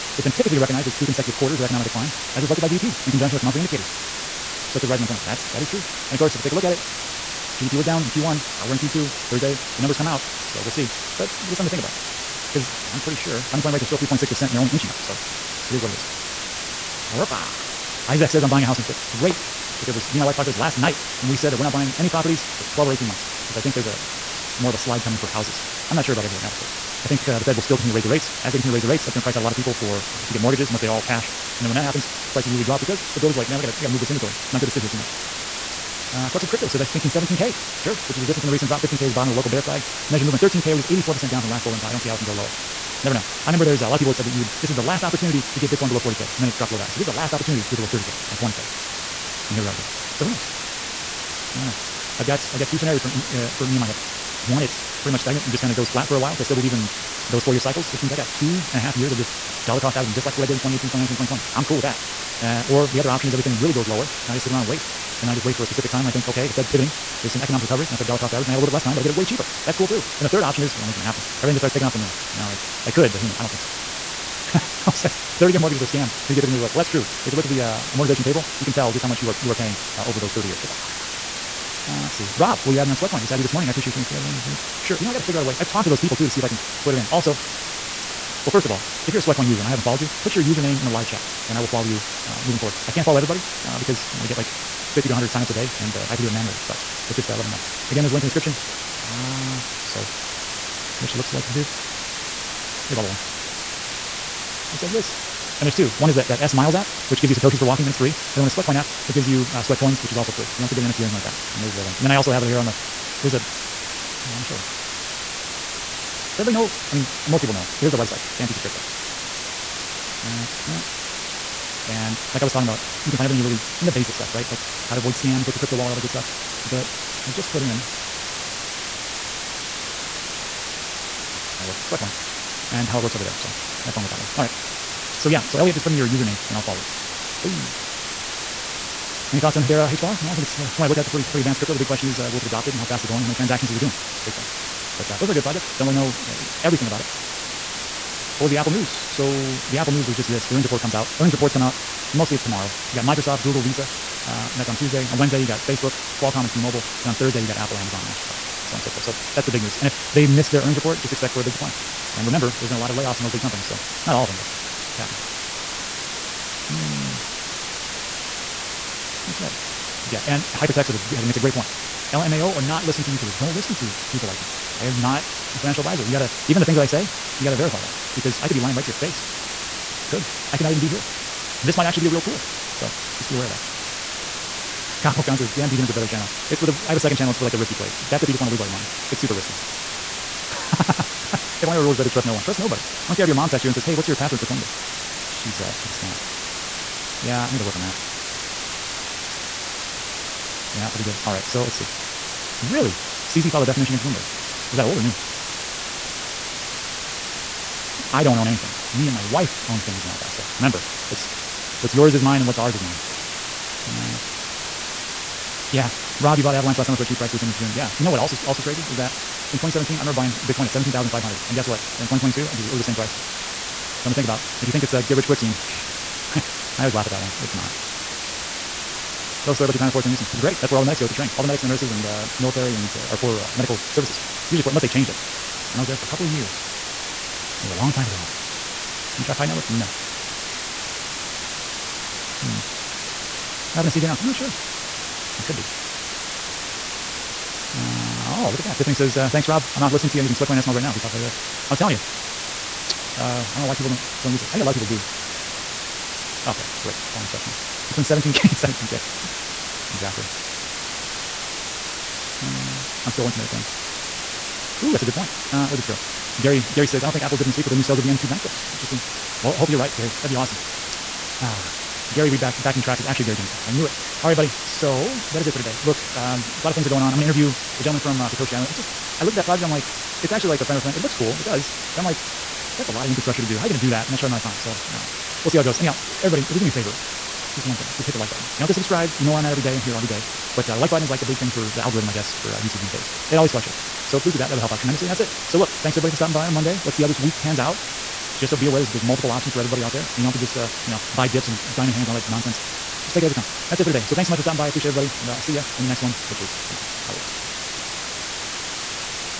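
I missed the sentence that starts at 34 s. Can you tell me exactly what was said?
It's not good to sit here too much." Uh, Crux of Crypto says, I'm thinking 17K.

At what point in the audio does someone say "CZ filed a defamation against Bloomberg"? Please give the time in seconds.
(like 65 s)
203 s.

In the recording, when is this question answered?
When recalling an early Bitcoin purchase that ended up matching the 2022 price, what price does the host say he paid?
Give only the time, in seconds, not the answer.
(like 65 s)
220 s.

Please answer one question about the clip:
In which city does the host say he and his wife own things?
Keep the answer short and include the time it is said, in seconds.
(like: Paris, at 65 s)
El Paso, at 210 s.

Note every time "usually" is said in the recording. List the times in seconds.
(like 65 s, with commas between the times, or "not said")
32 s, 234 s.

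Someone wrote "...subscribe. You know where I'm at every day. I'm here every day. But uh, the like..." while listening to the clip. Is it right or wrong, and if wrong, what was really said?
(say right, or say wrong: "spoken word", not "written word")
right.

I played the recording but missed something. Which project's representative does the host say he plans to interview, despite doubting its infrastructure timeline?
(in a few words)
Satoshi Island.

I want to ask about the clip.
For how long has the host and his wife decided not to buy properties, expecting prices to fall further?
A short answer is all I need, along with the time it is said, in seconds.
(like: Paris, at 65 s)
12 or 18, at 22 s.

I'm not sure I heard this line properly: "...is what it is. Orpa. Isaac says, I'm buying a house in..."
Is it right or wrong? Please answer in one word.
right.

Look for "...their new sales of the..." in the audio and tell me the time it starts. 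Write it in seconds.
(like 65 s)
267 s.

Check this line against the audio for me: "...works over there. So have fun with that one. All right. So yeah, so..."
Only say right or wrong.
right.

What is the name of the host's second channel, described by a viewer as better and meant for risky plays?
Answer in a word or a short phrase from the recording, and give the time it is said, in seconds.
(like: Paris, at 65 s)
Dan Degen, at 185 s.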